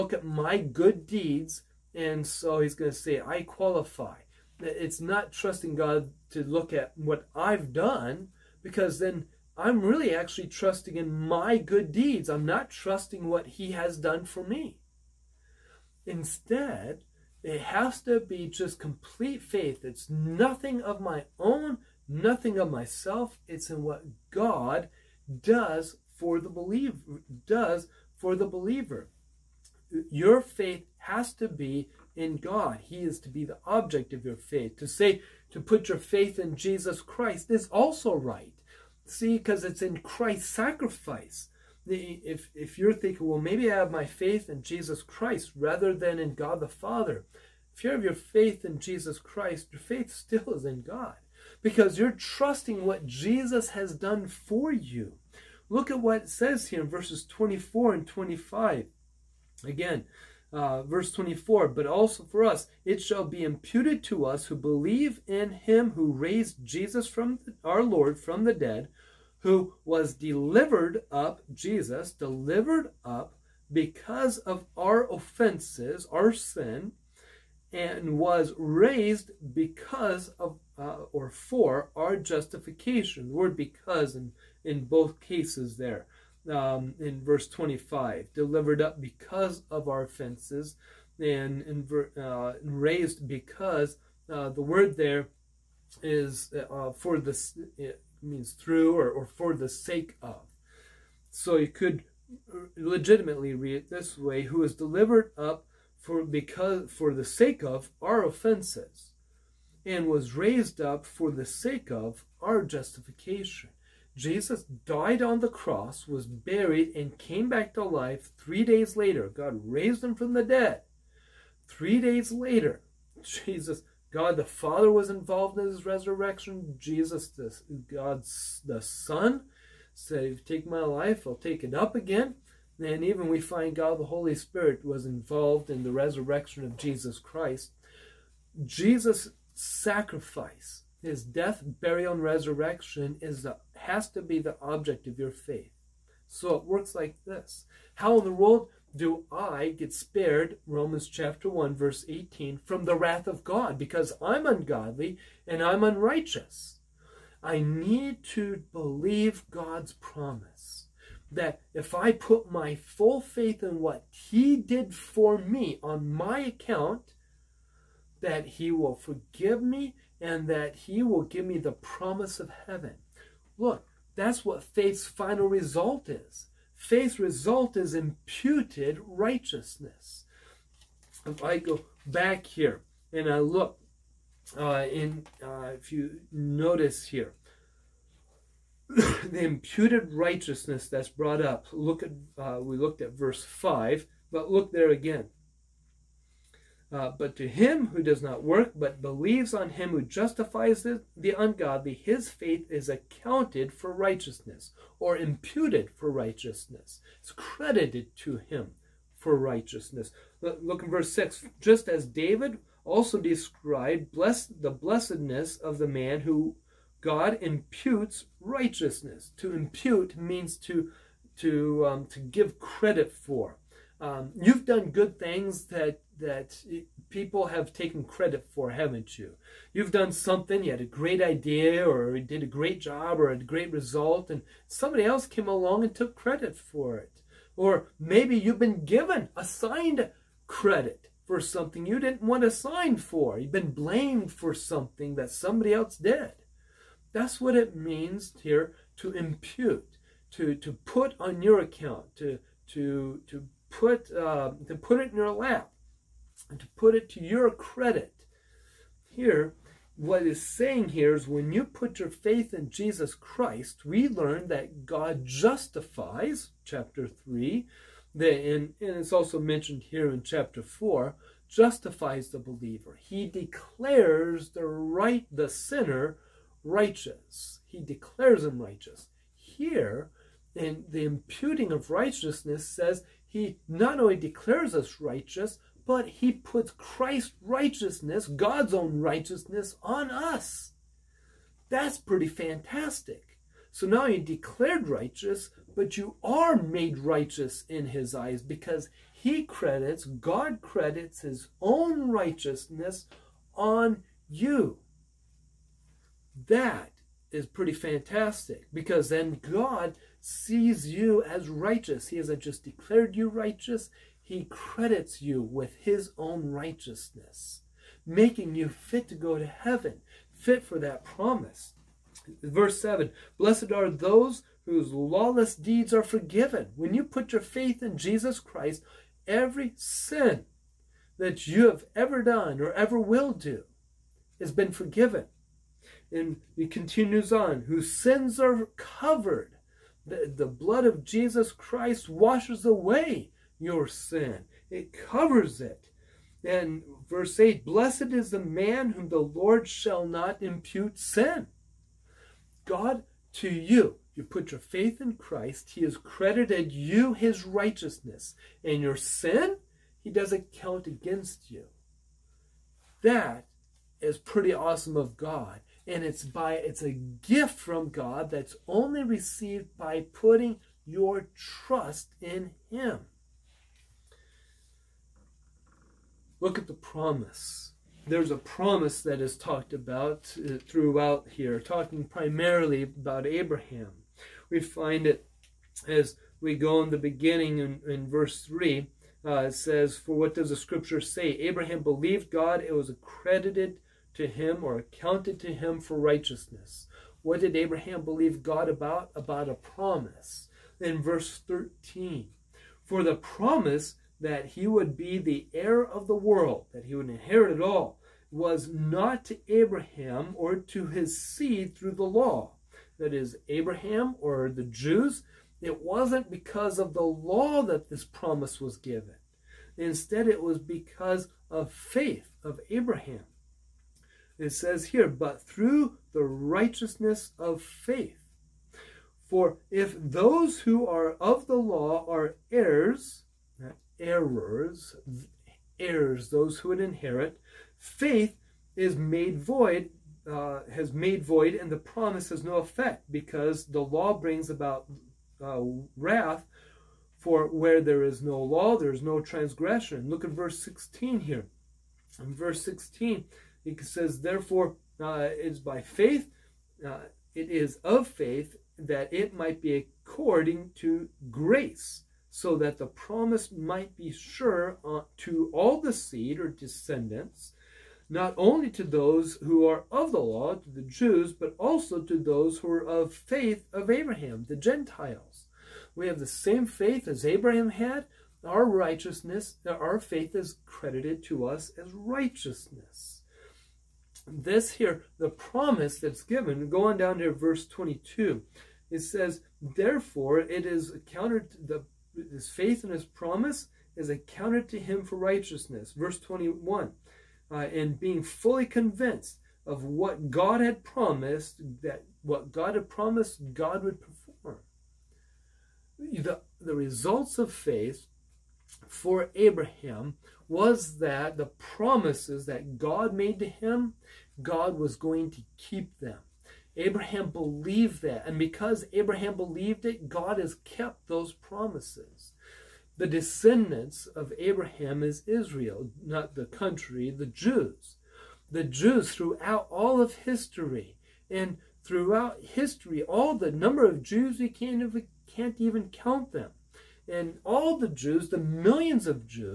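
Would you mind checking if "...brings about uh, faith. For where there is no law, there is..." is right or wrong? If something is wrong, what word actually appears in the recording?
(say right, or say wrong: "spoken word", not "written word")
wrong: "wrath", not "faith".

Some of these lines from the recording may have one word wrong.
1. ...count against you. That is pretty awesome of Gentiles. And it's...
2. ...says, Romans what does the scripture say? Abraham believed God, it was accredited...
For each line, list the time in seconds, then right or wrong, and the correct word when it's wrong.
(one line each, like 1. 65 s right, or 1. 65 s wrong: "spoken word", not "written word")
1. 360 s wrong: "God", not "Gentiles"
2. 389 s wrong: "For", not "Romans".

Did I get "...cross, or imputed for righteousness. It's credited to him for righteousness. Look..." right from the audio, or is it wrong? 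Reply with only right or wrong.
wrong.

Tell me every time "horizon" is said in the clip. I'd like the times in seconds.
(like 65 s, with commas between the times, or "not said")
not said.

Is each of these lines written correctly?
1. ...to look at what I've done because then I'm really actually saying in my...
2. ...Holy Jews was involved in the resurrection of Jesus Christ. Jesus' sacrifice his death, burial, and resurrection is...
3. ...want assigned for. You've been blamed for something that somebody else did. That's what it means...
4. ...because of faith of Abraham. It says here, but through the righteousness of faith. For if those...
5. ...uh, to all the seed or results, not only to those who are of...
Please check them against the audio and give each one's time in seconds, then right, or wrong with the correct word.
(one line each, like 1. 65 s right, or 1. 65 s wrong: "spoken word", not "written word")
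1. 6 s wrong: "trusting", not "saying"
2. 134 s wrong: "Spirit", not "Jews"
3. 242 s right
4. 420 s right
5. 464 s wrong: "descendants", not "results".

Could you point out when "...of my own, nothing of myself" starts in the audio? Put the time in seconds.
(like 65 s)
20 s.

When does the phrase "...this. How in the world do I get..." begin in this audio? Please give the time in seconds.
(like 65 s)
147 s.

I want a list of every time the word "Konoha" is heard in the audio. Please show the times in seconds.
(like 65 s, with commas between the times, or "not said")
not said.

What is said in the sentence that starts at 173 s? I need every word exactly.
Look, that's what faith's final result is.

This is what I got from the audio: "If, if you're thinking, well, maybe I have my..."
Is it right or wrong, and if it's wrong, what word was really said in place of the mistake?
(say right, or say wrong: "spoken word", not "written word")
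right.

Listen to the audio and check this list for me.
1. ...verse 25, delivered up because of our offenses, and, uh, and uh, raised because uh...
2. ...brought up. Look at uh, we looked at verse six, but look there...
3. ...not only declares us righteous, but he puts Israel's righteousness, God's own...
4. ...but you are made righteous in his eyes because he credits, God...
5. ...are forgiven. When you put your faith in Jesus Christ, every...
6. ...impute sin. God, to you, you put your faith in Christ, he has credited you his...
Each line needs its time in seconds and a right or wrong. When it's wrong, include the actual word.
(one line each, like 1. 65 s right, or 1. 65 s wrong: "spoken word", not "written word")
1. 87 s right
2. 191 s wrong: "five", not "six"
3. 283 s wrong: "Christ", not "Israel"
4. 295 s right
5. 325 s right
6. 350 s right.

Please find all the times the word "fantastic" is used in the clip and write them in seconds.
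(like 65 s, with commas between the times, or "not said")
292 s, 307 s.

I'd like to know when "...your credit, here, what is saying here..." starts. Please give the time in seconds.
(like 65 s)
257 s.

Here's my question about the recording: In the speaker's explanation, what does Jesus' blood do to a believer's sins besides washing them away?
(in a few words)
covers it.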